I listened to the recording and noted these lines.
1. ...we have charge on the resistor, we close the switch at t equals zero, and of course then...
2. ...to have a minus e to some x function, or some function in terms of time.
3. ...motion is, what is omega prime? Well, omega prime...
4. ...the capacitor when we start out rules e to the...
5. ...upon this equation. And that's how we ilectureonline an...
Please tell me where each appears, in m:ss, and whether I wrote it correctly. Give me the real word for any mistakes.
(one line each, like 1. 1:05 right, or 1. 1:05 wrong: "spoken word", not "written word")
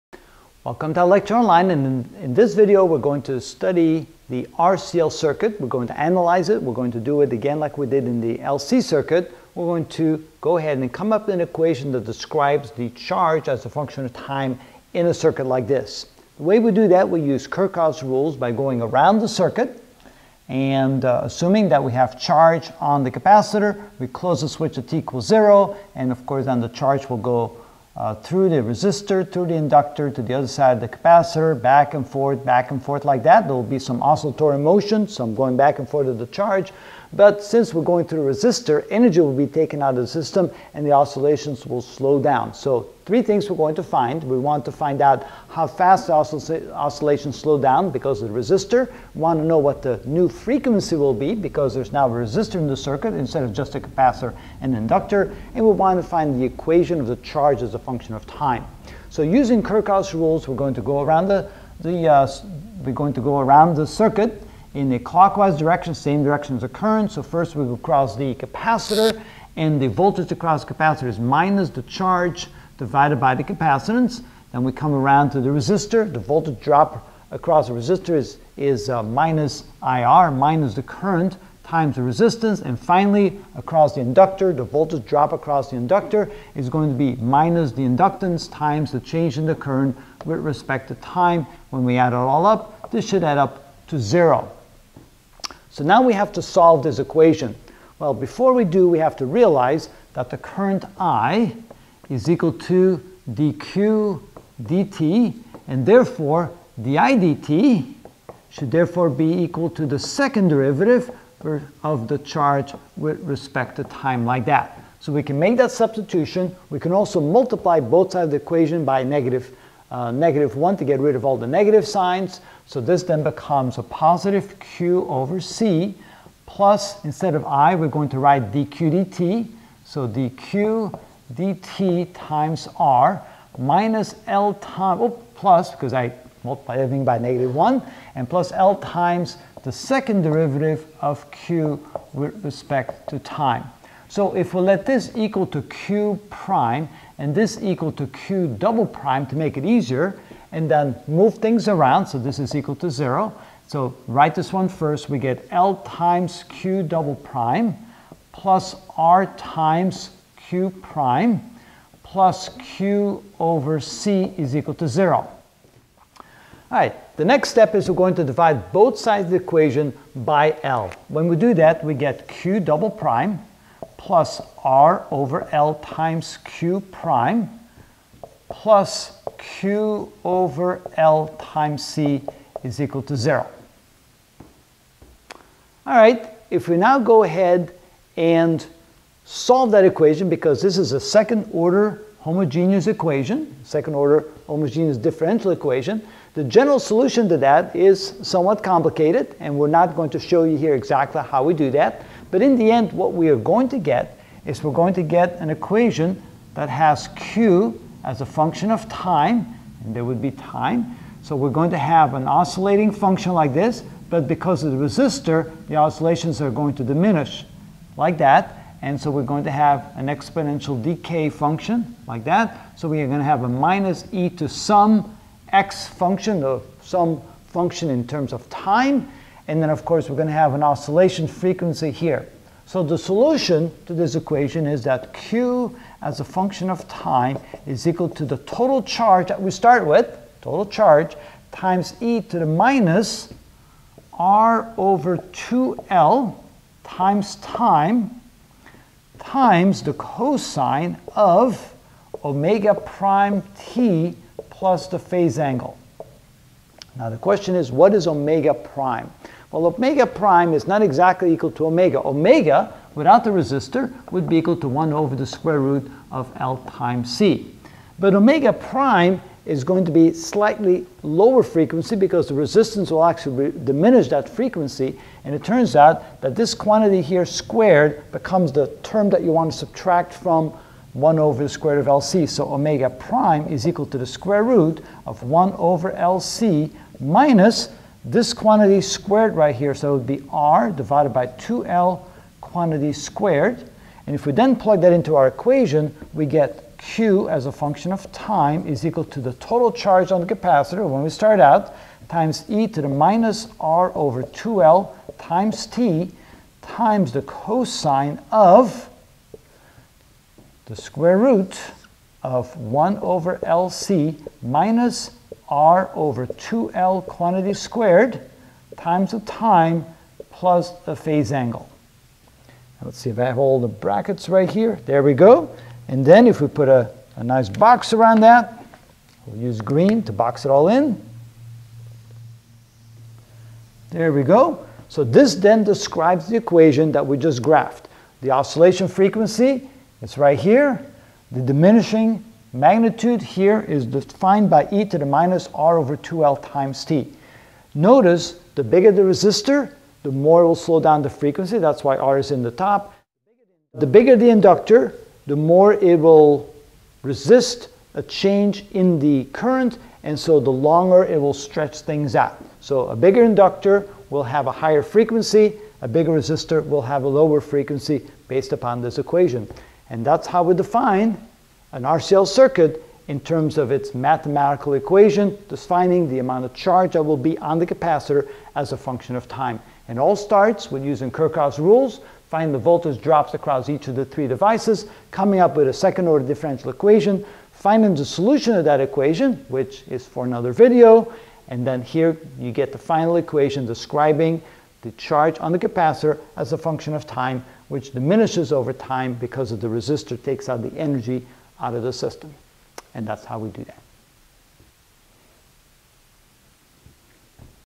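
1. 0:21 wrong: "capacitor", not "resistor"
2. 3:43 right
3. 4:17 wrong: "question", not "motion"
4. 5:00 wrong: "times", not "rules"
5. 6:08 wrong: "define", not "ilectureonline".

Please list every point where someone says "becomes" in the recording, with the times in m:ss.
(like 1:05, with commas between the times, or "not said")
2:03, 4:38.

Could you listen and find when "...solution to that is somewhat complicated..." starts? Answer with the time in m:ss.
3:16.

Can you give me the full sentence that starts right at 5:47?
Notice the bigger the resistor, the more it will slow down the frequency.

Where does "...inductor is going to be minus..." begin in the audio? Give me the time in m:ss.
1:25.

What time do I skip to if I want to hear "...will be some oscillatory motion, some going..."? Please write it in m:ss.
0:33.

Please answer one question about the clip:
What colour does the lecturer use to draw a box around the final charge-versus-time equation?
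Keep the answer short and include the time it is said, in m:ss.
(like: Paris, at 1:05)
Green, at 5:29.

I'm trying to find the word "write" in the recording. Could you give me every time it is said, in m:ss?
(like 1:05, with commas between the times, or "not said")
2:08, 2:34.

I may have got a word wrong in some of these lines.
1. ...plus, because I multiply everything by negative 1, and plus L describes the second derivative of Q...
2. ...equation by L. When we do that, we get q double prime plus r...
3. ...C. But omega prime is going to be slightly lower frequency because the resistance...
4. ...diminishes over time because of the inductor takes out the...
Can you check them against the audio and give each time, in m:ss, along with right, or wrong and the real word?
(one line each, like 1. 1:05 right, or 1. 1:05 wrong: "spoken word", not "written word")
1. 2:15 wrong: "times", not "describes"
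2. 2:49 right
3. 4:27 right
4. 6:37 wrong: "resistor", not "inductor".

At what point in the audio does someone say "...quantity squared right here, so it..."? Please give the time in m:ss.
4:48.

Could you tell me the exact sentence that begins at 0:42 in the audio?
So three things we're going to find.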